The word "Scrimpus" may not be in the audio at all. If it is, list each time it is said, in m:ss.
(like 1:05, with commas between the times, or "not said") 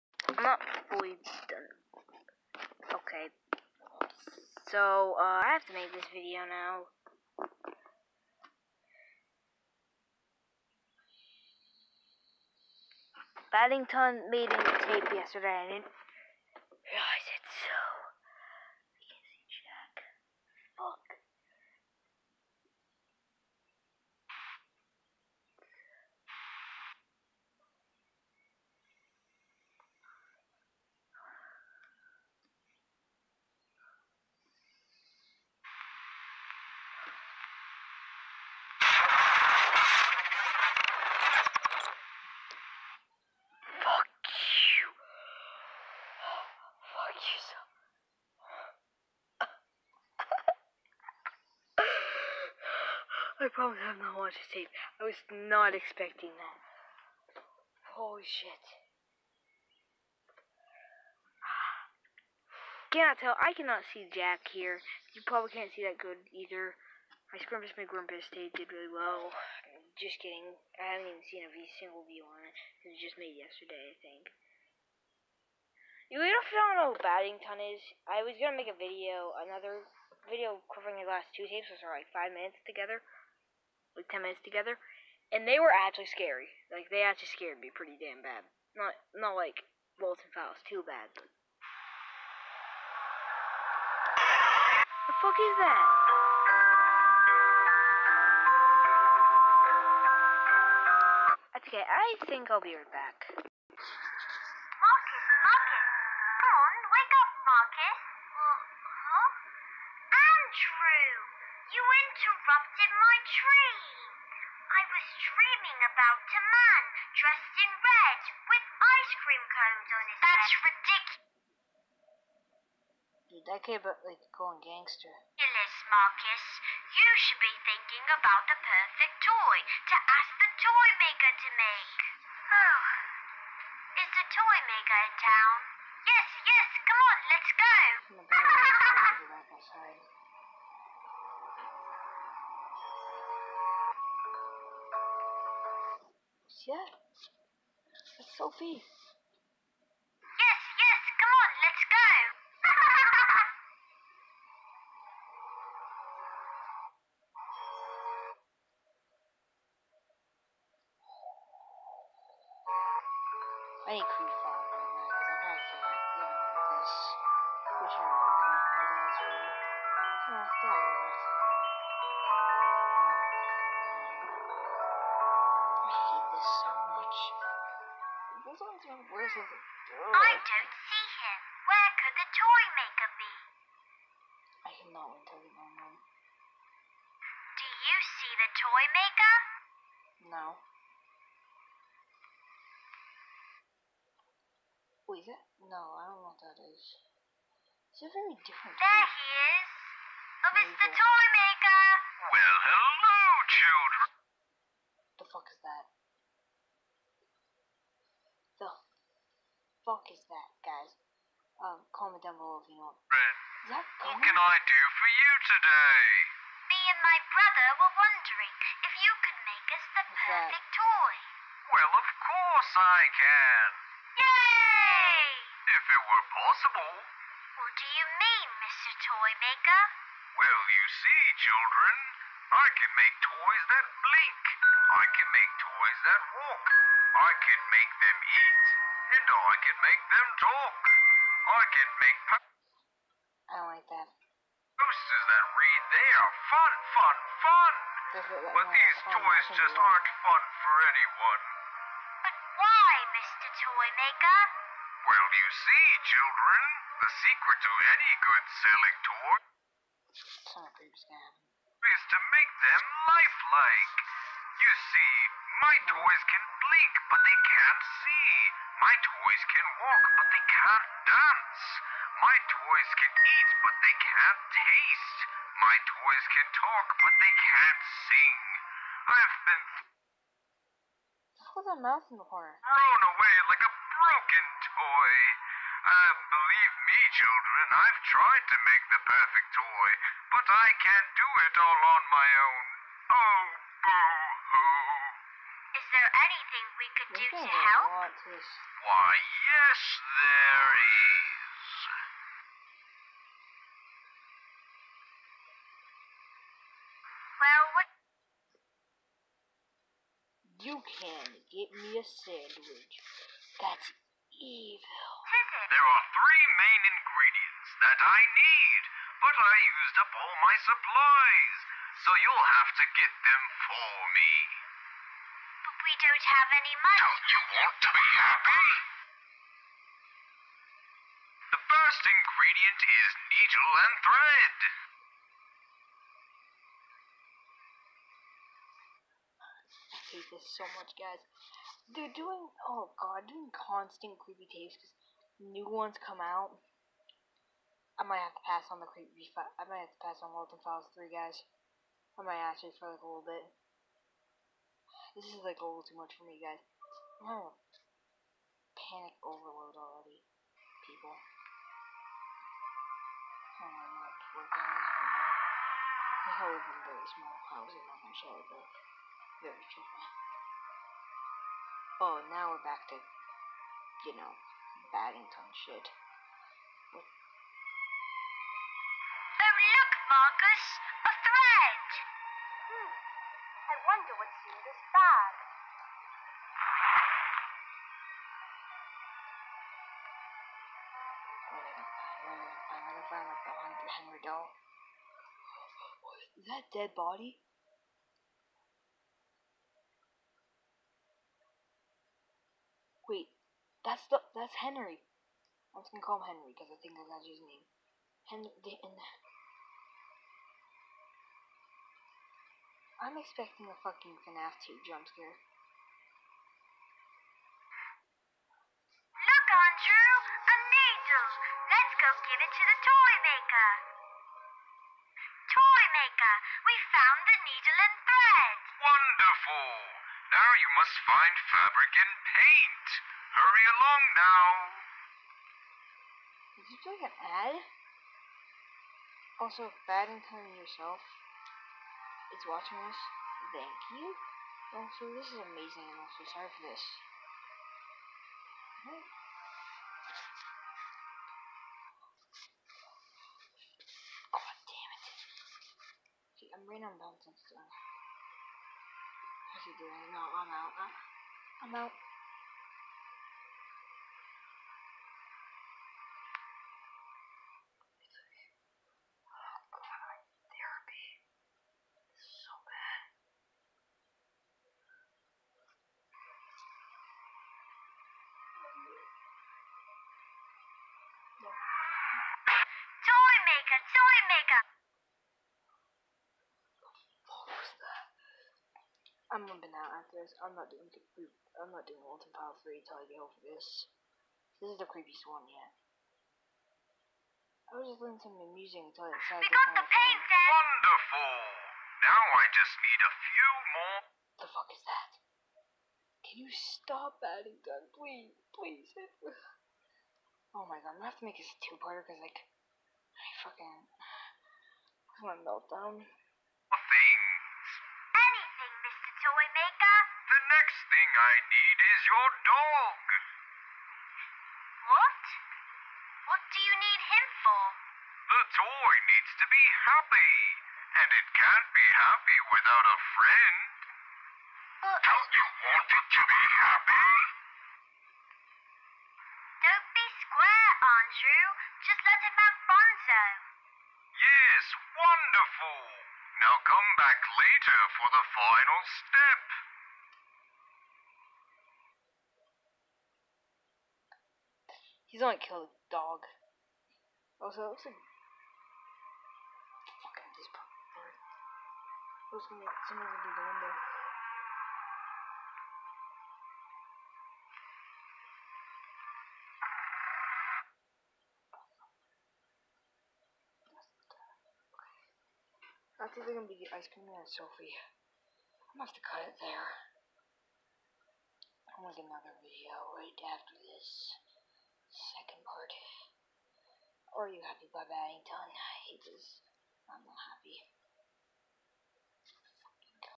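1:07.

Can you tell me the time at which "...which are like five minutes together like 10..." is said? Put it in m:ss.
1:21.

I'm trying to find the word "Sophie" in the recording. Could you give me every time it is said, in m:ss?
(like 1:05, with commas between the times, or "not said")
2:28, 9:37.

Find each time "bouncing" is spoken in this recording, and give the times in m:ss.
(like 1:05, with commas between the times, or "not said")
7:36.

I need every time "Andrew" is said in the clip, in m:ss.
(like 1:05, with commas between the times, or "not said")
6:59, 9:01.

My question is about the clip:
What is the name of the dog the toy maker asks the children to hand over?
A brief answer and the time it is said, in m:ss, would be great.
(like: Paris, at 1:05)
Bonzo, at 9:02.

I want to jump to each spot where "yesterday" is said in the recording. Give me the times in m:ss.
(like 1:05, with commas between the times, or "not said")
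0:15, 1:13.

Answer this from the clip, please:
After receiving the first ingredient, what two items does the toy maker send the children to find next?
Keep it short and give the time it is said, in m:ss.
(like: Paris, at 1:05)
Fabric and paint, at 7:11.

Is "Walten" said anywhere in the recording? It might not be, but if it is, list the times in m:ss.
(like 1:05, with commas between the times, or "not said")
1:29, 5:50, 8:12.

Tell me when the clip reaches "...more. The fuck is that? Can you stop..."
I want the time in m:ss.
8:23.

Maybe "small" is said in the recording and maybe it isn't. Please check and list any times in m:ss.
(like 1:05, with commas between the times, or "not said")
6:07.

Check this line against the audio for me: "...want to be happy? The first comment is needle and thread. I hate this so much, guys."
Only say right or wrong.
wrong.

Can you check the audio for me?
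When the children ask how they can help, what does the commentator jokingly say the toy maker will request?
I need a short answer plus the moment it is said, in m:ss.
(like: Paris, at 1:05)
A sandwich, at 5:12.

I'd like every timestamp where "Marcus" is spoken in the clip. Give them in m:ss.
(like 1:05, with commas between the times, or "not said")
2:05, 6:20.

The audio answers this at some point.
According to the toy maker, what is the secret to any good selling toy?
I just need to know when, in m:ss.
4:22.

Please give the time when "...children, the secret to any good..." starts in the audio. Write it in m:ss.
4:16.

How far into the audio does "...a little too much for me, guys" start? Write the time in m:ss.
5:55.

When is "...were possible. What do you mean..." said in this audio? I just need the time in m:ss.
3:46.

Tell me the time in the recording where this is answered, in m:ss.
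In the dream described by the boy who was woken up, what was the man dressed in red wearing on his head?
1:58.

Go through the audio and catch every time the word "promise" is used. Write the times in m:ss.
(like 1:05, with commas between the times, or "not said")
0:53.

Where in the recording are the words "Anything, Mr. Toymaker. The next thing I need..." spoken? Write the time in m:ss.
8:38.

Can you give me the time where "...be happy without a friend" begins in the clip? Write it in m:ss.
8:51.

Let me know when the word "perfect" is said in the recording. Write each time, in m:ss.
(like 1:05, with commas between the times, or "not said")
2:08, 3:40, 4:49.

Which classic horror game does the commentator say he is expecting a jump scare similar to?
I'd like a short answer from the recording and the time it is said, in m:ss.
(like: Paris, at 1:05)
FNAF 2, at 6:54.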